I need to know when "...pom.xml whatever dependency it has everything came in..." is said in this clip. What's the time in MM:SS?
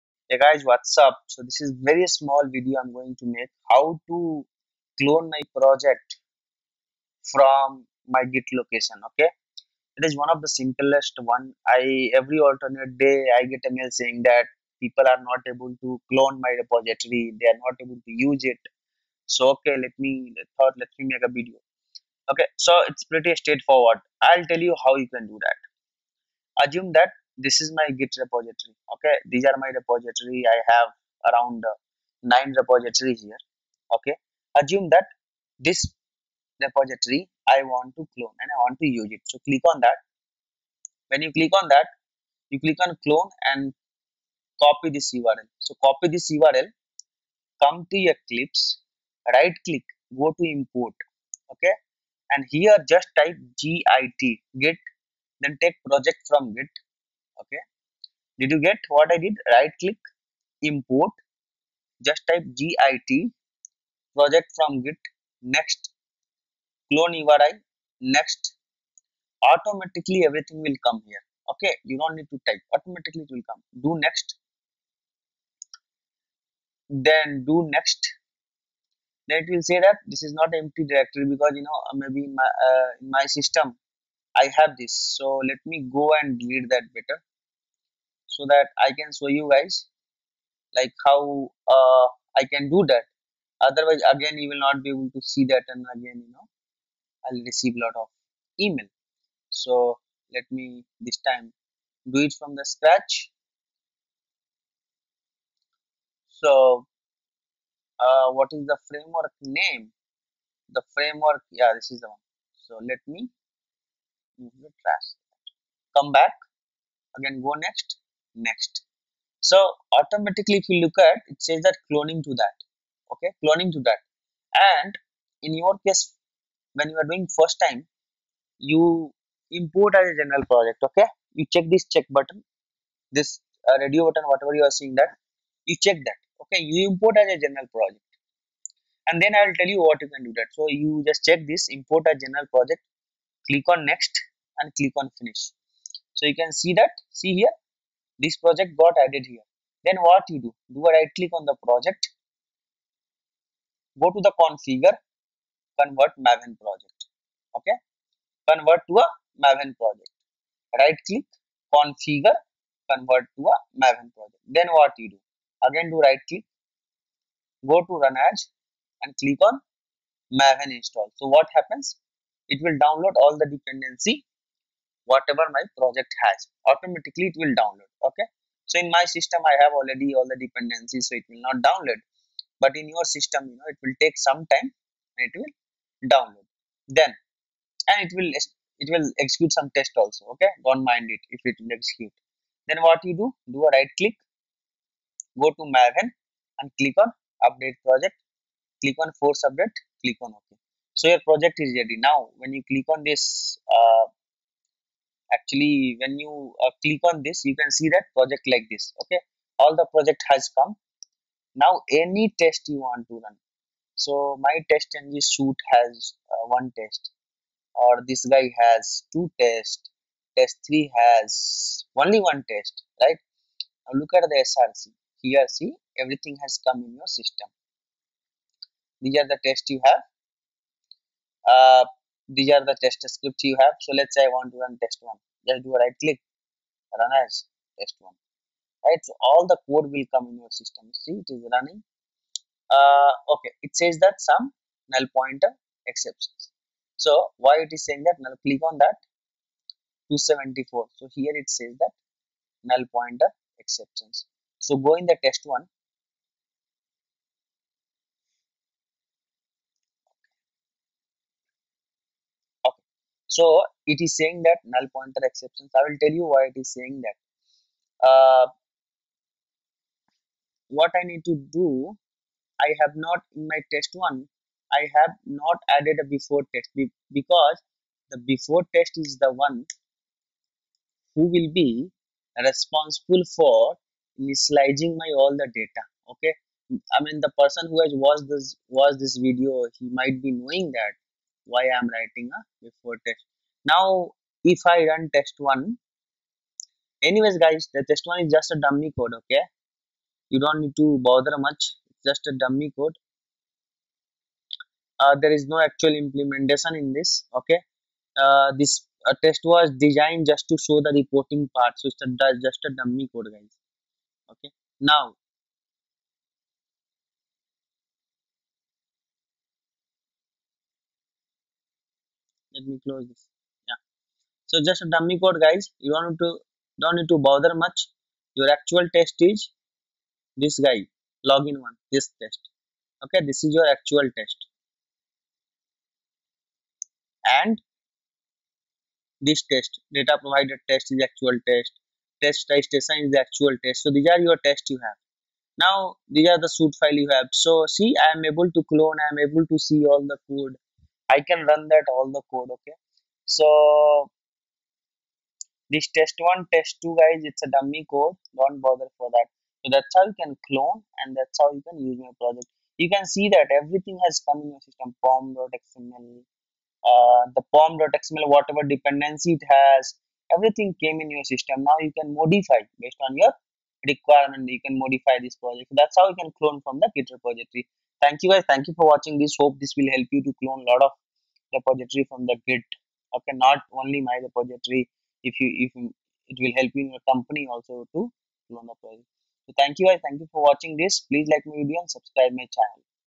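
06:07.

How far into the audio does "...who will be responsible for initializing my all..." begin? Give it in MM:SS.
04:41.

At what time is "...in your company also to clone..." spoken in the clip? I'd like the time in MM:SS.
06:26.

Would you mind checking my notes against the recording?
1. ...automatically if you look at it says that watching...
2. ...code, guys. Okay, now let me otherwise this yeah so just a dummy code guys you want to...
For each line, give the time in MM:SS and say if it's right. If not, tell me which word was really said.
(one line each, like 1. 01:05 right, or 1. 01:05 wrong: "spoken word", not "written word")
1. 01:59 wrong: "cloning", not "watching"
2. 05:13 wrong: "close", not "otherwise".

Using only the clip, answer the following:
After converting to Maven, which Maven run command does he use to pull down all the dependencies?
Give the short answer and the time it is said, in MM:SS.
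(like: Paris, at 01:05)
Maven install, at 02:50.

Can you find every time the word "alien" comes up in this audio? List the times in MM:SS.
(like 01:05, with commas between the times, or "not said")
not said.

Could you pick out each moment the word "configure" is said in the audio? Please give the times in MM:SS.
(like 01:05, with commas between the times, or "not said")
02:34, 02:41.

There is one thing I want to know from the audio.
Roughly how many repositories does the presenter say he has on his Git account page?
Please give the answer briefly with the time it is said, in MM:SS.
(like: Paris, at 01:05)
9, at 00:32.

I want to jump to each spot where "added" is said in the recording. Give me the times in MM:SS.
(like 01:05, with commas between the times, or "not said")
02:29, 04:35.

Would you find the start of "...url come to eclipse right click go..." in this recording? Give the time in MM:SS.
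00:46.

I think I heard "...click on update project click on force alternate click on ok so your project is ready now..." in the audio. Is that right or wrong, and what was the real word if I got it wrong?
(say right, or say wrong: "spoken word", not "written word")
wrong: "update", not "alternate".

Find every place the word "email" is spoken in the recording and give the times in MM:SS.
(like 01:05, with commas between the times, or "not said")
01:38.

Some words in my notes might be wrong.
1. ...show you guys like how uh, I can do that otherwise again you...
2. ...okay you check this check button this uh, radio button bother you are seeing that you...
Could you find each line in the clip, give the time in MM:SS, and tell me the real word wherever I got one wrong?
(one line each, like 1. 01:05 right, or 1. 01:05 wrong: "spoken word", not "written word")
1. 01:29 right
2. 02:10 wrong: "whatever", not "bother".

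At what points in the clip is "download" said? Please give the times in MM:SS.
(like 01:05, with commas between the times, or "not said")
02:52, 02:57, 03:01, 03:06.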